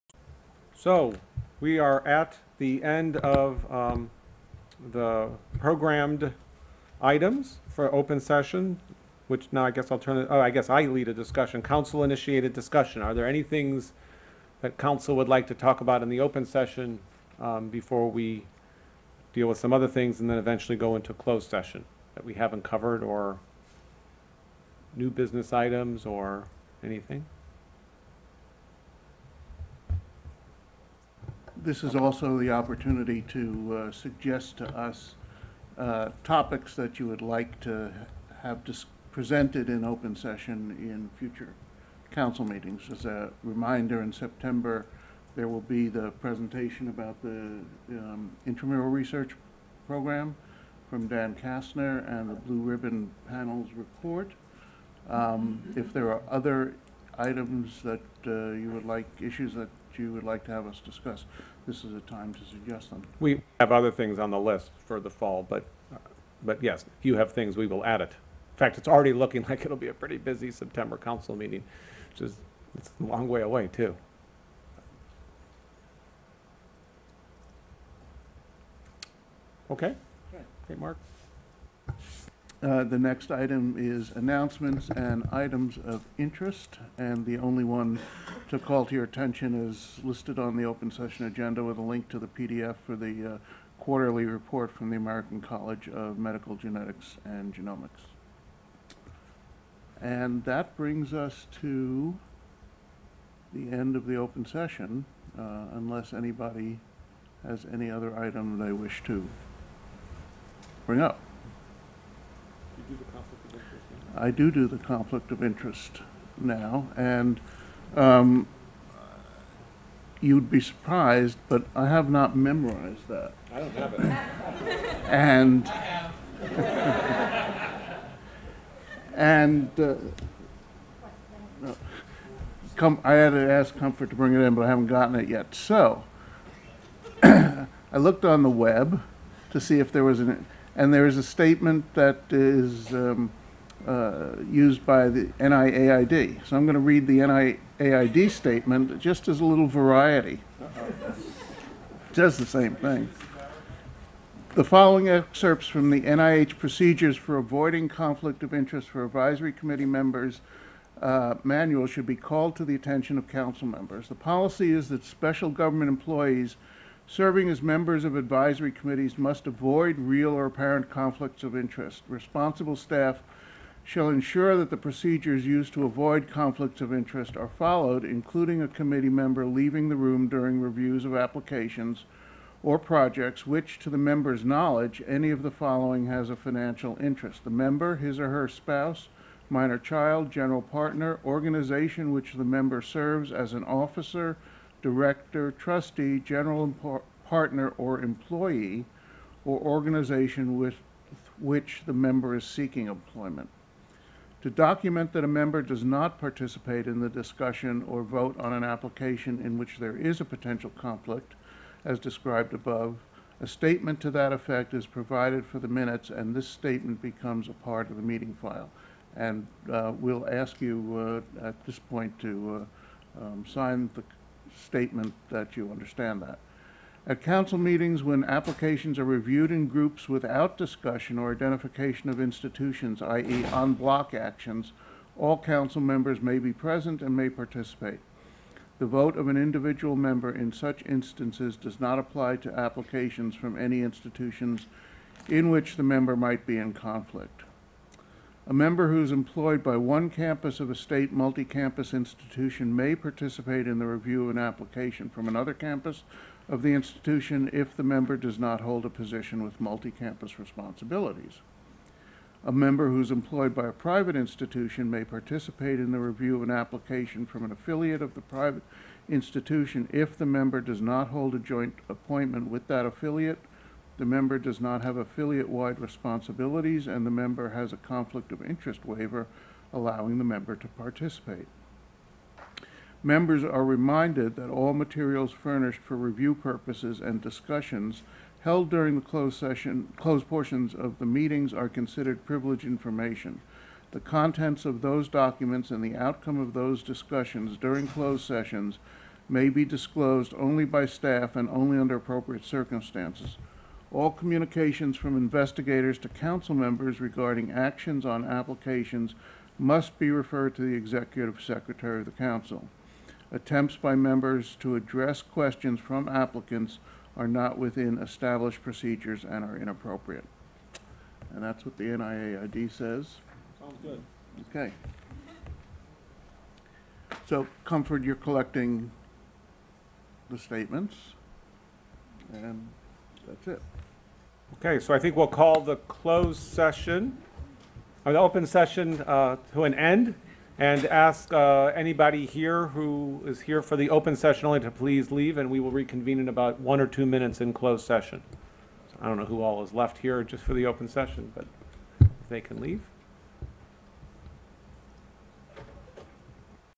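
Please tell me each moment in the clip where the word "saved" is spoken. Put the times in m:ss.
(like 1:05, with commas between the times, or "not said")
not said.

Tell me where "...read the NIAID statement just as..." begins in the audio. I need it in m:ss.
2:26.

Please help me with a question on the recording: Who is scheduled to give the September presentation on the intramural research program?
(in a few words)
Dan Kastner.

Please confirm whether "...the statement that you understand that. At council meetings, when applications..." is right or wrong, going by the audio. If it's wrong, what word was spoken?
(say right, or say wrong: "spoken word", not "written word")
right.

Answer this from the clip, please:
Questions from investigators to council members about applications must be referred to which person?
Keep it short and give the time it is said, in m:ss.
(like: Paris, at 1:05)
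executive secretary of the council, at 5:10.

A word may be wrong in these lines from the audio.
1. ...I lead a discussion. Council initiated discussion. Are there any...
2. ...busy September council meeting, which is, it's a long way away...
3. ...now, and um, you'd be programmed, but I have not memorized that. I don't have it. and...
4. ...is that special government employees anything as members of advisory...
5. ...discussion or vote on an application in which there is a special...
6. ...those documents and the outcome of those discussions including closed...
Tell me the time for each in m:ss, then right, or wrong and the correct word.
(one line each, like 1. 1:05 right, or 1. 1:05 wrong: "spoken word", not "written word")
1. 0:10 right
2. 1:10 right
3. 1:56 wrong: "surprised", not "programmed"
4. 2:44 wrong: "serving", not "anything"
5. 3:27 wrong: "potential", not "special"
6. 4:54 wrong: "during", not "including".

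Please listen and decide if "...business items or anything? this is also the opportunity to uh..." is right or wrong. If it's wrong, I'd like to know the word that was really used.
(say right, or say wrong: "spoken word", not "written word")
right.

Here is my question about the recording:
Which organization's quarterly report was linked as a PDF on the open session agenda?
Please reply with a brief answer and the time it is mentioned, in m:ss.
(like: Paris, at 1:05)
American College of Medical Genetics and Genomics, at 1:34.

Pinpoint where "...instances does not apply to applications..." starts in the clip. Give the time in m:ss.
4:00.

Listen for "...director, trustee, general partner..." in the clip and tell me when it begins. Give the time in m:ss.
3:14.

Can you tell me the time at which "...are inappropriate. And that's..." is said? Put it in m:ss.
5:19.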